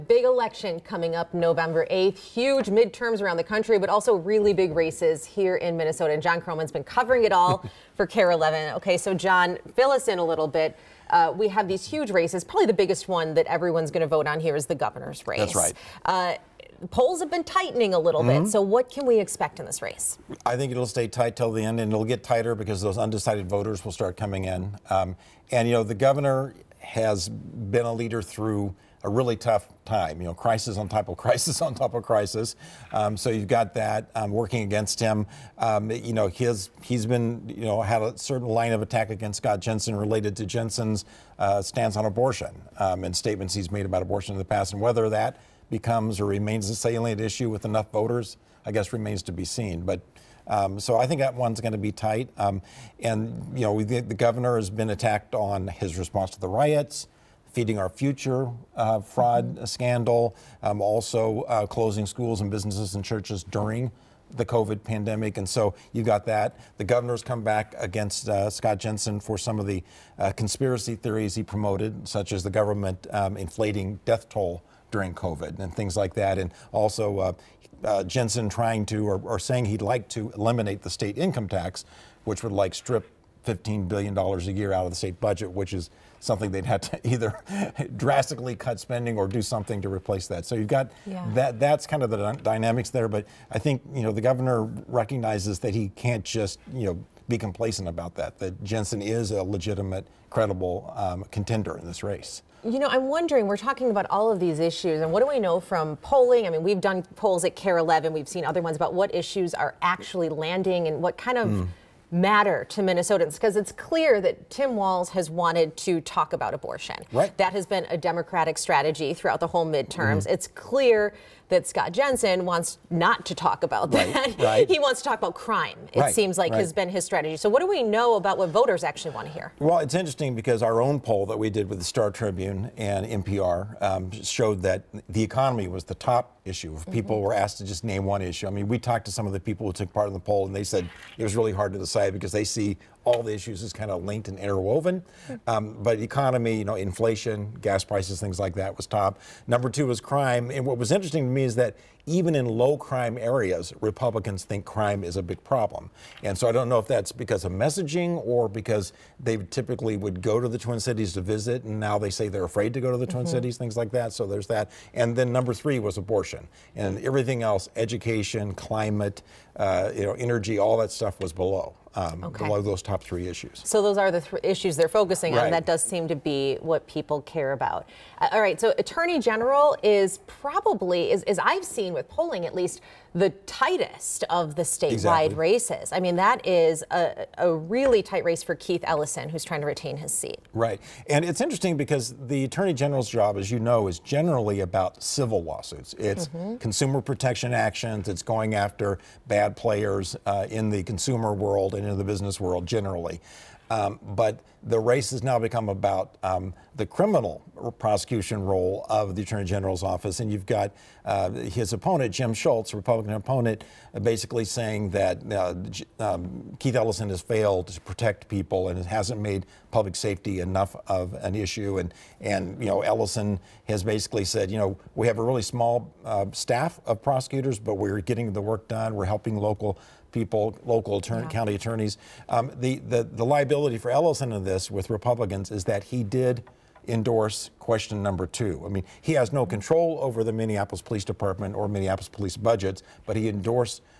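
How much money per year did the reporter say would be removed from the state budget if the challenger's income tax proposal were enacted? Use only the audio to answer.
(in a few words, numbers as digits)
$15 billion.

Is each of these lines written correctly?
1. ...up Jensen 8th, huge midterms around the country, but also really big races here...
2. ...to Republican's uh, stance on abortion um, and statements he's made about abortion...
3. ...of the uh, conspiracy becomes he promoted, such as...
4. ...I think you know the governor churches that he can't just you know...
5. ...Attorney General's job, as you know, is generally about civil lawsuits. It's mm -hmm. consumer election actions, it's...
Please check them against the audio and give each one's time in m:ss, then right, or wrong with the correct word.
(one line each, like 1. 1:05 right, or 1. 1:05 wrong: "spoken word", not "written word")
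1. 0:01 wrong: "November", not "Jensen"
2. 0:40 wrong: "Jensen", not "Republican"
3. 1:09 wrong: "theories", not "becomes"
4. 1:33 wrong: "recognizes", not "churches"
5. 3:12 wrong: "protection", not "election".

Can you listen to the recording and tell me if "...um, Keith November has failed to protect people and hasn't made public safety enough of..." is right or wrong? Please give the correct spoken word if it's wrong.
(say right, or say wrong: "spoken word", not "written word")
wrong: "Ellison", not "November".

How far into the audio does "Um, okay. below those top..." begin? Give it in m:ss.
2:51.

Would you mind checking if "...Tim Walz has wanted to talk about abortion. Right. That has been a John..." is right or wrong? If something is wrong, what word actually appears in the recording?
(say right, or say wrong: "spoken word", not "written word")
wrong: "Democratic", not "John".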